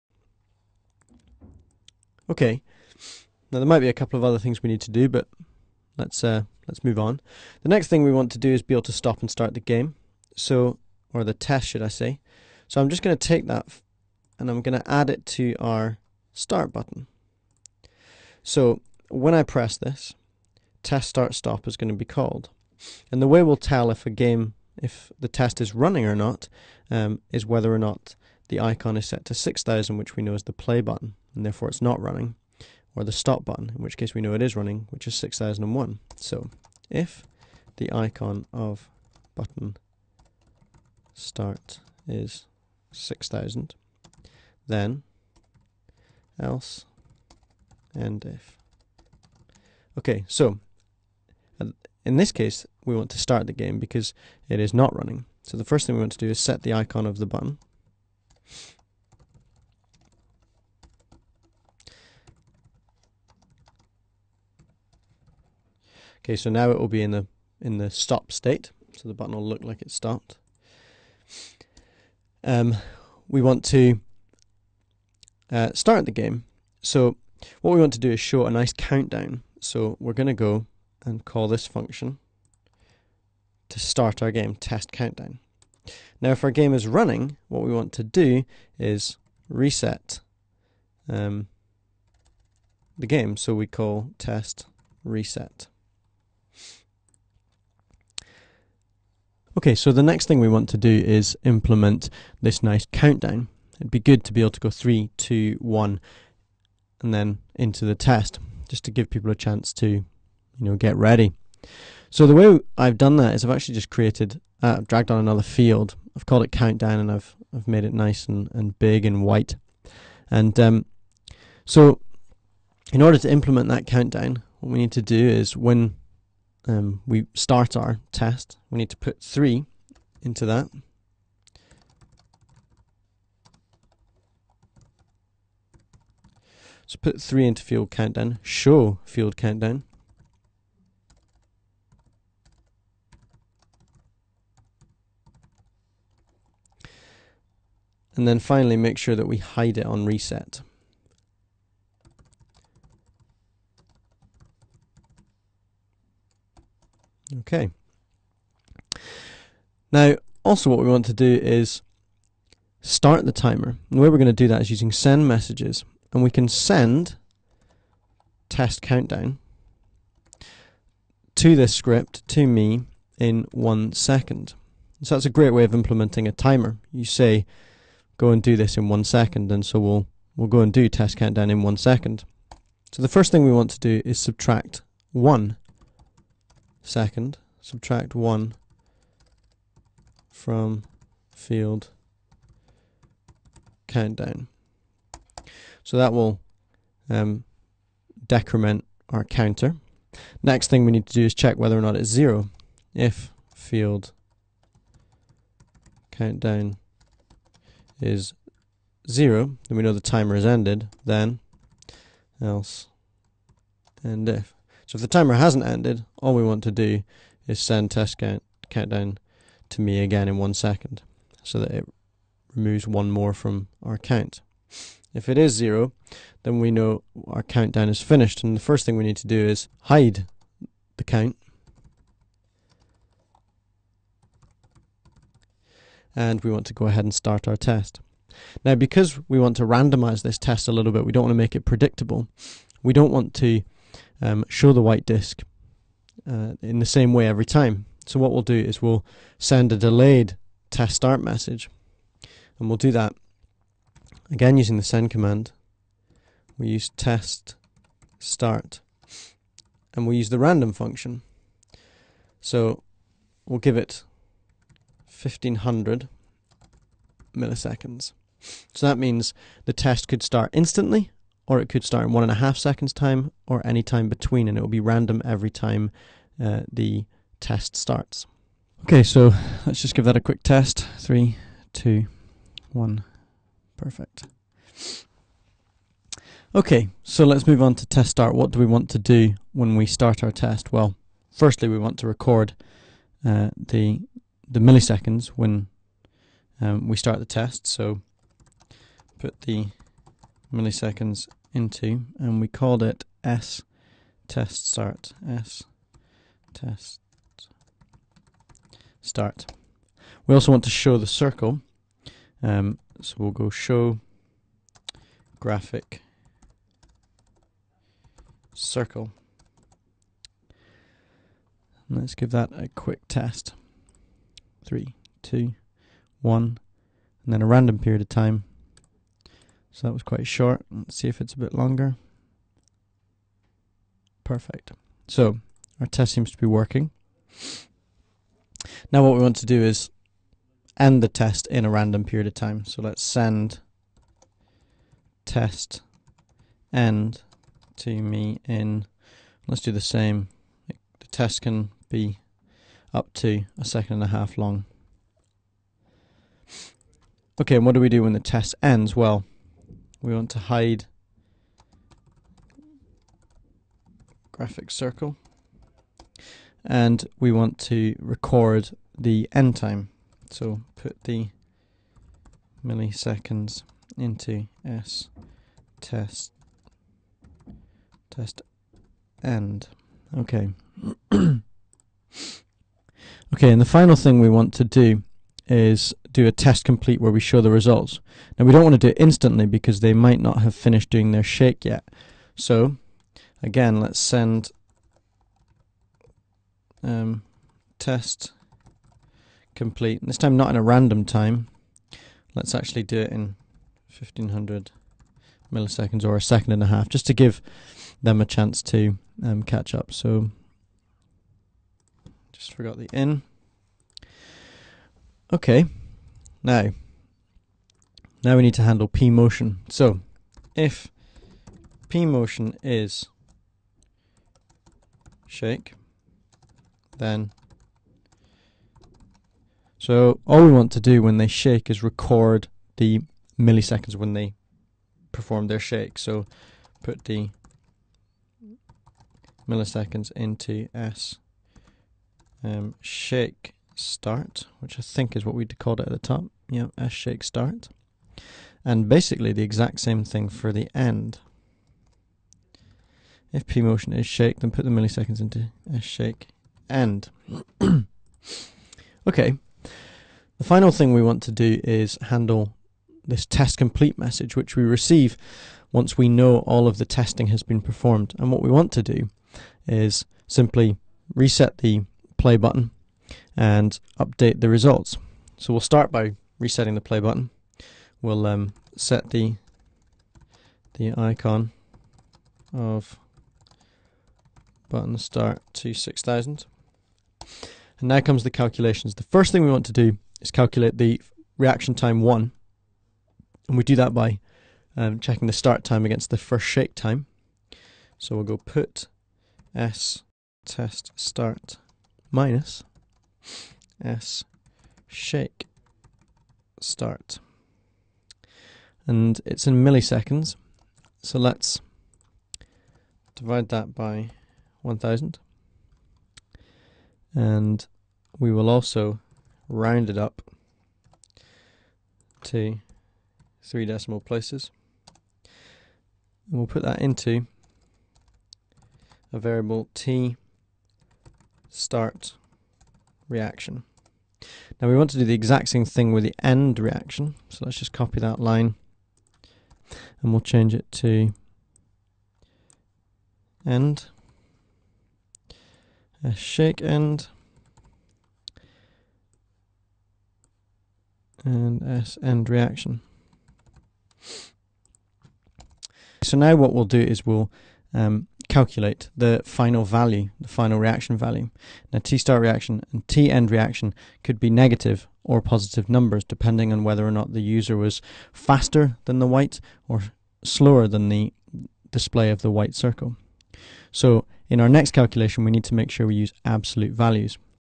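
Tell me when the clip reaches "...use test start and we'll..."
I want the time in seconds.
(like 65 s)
256 s.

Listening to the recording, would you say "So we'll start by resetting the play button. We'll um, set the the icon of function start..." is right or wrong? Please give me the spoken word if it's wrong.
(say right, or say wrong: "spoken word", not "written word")
wrong: "button", not "function".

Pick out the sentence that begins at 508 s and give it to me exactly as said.
And it's in milliseconds, so let's divide that by 1000.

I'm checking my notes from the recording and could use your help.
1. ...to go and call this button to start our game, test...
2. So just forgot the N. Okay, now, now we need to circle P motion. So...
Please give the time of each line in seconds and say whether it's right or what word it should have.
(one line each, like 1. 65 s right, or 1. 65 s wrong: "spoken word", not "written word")
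1. 80 s wrong: "function", not "button"
2. 409 s wrong: "handle", not "circle".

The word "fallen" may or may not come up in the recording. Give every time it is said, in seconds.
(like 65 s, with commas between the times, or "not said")
not said.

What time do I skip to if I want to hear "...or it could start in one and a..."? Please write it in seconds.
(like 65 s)
271 s.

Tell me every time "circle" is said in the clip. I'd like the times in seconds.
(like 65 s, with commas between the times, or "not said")
311 s, 318 s, 364 s, 572 s.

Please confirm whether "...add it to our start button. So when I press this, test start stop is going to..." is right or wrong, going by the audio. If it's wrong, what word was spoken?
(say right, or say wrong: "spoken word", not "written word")
right.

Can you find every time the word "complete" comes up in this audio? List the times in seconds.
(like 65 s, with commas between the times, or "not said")
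386 s, 399 s, 463 s.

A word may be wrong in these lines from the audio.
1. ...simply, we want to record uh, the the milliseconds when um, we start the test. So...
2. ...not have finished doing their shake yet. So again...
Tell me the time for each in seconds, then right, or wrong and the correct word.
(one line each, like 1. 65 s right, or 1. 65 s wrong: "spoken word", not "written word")
1. 291 s wrong: "firstly", not "simply"
2. 390 s right.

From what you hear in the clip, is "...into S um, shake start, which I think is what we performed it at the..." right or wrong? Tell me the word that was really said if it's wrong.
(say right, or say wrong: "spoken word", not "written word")
wrong: "called", not "performed".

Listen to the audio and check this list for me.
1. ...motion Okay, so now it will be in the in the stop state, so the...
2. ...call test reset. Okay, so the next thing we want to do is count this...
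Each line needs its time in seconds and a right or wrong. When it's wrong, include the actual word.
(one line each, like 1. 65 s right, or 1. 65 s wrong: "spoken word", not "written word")
1. 57 s wrong: "button", not "motion"
2. 93 s wrong: "implement", not "count".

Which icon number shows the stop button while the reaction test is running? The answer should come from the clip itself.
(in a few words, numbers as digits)
6001.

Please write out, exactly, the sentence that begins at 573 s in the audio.
So in our next calculation, we need to make sure we use absolute values.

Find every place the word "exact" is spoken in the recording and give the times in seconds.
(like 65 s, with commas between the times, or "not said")
449 s, 535 s.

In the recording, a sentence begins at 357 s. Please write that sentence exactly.
Okay, and what do we do when the test ends?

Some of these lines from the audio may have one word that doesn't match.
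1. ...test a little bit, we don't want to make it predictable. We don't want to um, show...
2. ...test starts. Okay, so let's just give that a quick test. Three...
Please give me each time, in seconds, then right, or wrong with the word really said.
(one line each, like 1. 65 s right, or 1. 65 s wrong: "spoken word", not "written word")
1. 240 s right
2. 277 s right.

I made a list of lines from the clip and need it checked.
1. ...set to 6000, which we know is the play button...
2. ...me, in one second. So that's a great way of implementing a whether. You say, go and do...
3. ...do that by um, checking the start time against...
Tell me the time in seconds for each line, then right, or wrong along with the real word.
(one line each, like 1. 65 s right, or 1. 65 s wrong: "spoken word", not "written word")
1. 29 s right
2. 172 s wrong: "timer", not "whether"
3. 493 s right.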